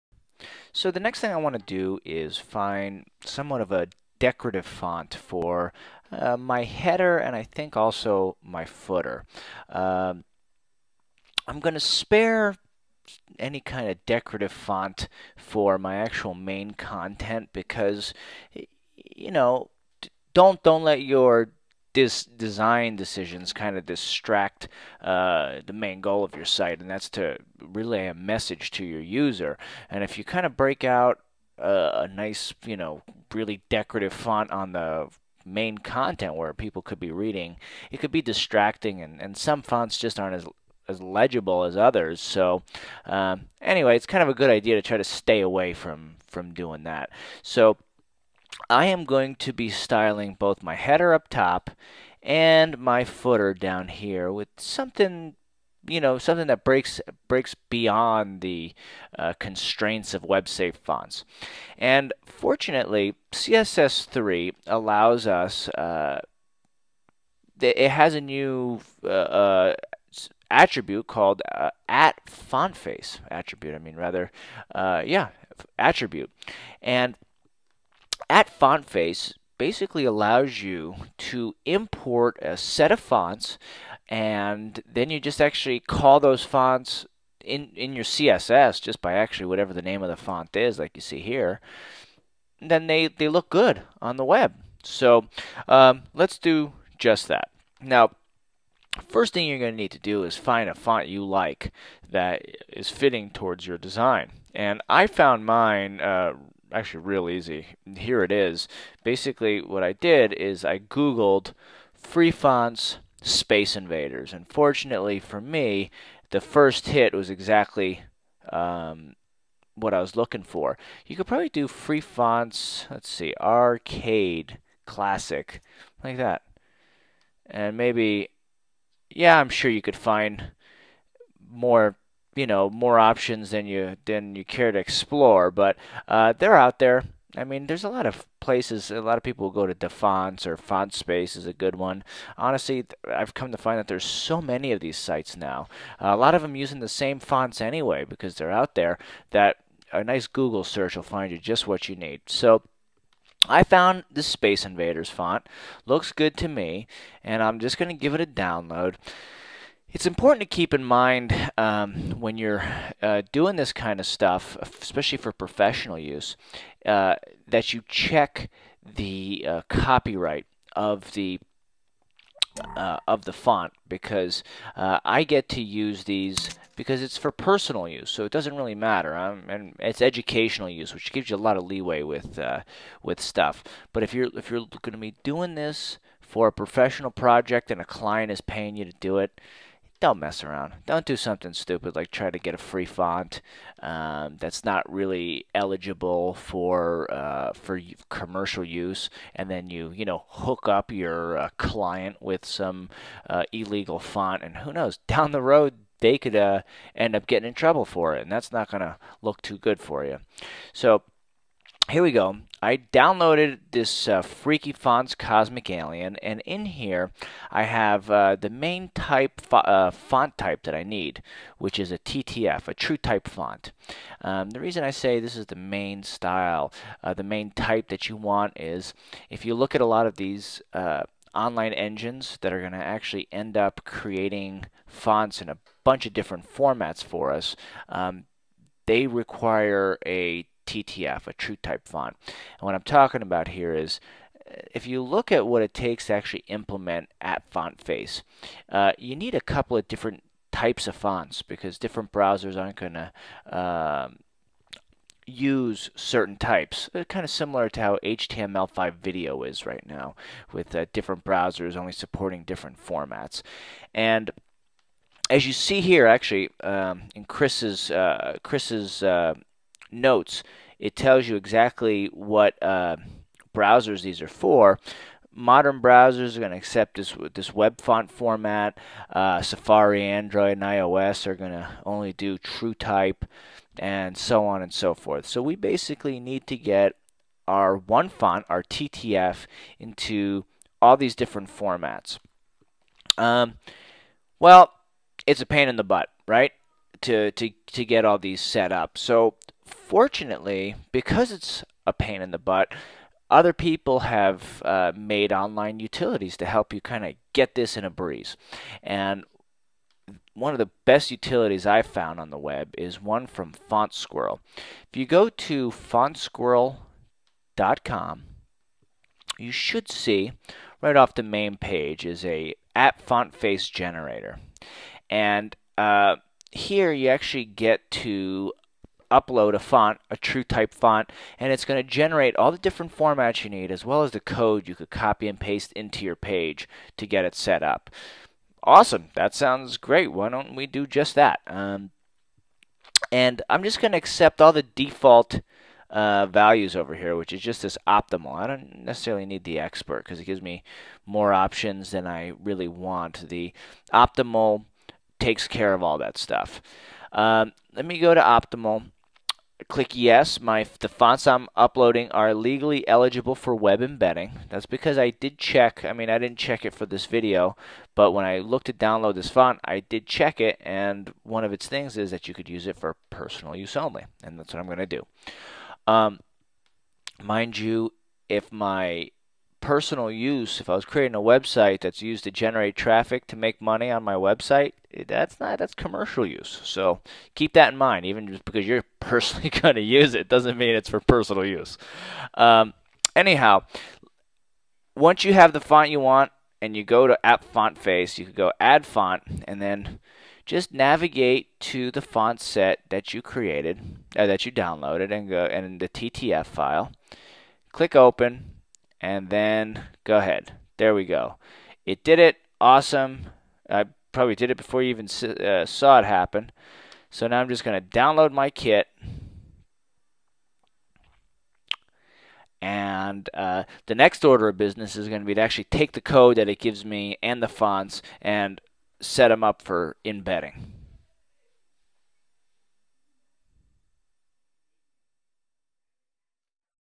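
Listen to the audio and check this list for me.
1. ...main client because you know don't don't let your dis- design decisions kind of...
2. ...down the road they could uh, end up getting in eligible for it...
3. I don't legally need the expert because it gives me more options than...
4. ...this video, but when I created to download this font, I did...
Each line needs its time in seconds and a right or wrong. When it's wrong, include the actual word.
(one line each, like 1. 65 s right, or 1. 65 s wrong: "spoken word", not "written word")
1. 16 s wrong: "content", not "client"
2. 205 s wrong: "trouble", not "eligible"
3. 348 s wrong: "necessarily", not "legally"
4. 366 s wrong: "looked", not "created".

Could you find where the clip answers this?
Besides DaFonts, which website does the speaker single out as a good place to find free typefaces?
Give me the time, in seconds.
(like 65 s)
140 s.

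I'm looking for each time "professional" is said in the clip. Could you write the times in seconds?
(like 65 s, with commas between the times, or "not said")
165 s, 186 s.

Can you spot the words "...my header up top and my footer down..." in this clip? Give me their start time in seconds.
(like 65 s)
50 s.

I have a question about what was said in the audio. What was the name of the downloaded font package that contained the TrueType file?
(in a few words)
Freaky Fonts Cosmic Alien.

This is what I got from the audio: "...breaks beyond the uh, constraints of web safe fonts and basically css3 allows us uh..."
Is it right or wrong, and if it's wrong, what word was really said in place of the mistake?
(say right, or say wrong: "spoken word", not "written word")
wrong: "fortunately", not "basically".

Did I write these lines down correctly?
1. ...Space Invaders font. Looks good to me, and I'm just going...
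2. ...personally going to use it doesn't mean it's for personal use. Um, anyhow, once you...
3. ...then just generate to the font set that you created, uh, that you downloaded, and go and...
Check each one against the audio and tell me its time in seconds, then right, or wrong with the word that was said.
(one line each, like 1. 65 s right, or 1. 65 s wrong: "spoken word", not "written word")
1. 154 s right
2. 388 s right
3. 399 s wrong: "navigate", not "generate".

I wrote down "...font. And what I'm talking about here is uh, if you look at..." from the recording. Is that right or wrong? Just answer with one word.
right.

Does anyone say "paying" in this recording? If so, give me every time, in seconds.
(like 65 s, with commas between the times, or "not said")
188 s.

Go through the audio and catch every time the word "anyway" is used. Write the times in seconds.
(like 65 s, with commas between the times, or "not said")
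43 s, 147 s.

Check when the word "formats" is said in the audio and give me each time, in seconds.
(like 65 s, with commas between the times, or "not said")
236 s, 262 s, 278 s, 291 s, 332 s.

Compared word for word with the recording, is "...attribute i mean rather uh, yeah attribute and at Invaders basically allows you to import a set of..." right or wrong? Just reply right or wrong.
wrong.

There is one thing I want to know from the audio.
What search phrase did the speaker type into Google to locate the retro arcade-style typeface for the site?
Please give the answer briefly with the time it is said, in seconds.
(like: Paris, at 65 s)
free fonts Space Invaders, at 111 s.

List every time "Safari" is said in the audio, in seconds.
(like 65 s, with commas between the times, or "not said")
279 s.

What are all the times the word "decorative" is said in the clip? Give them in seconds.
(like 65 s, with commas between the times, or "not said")
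4 s, 14 s, 33 s.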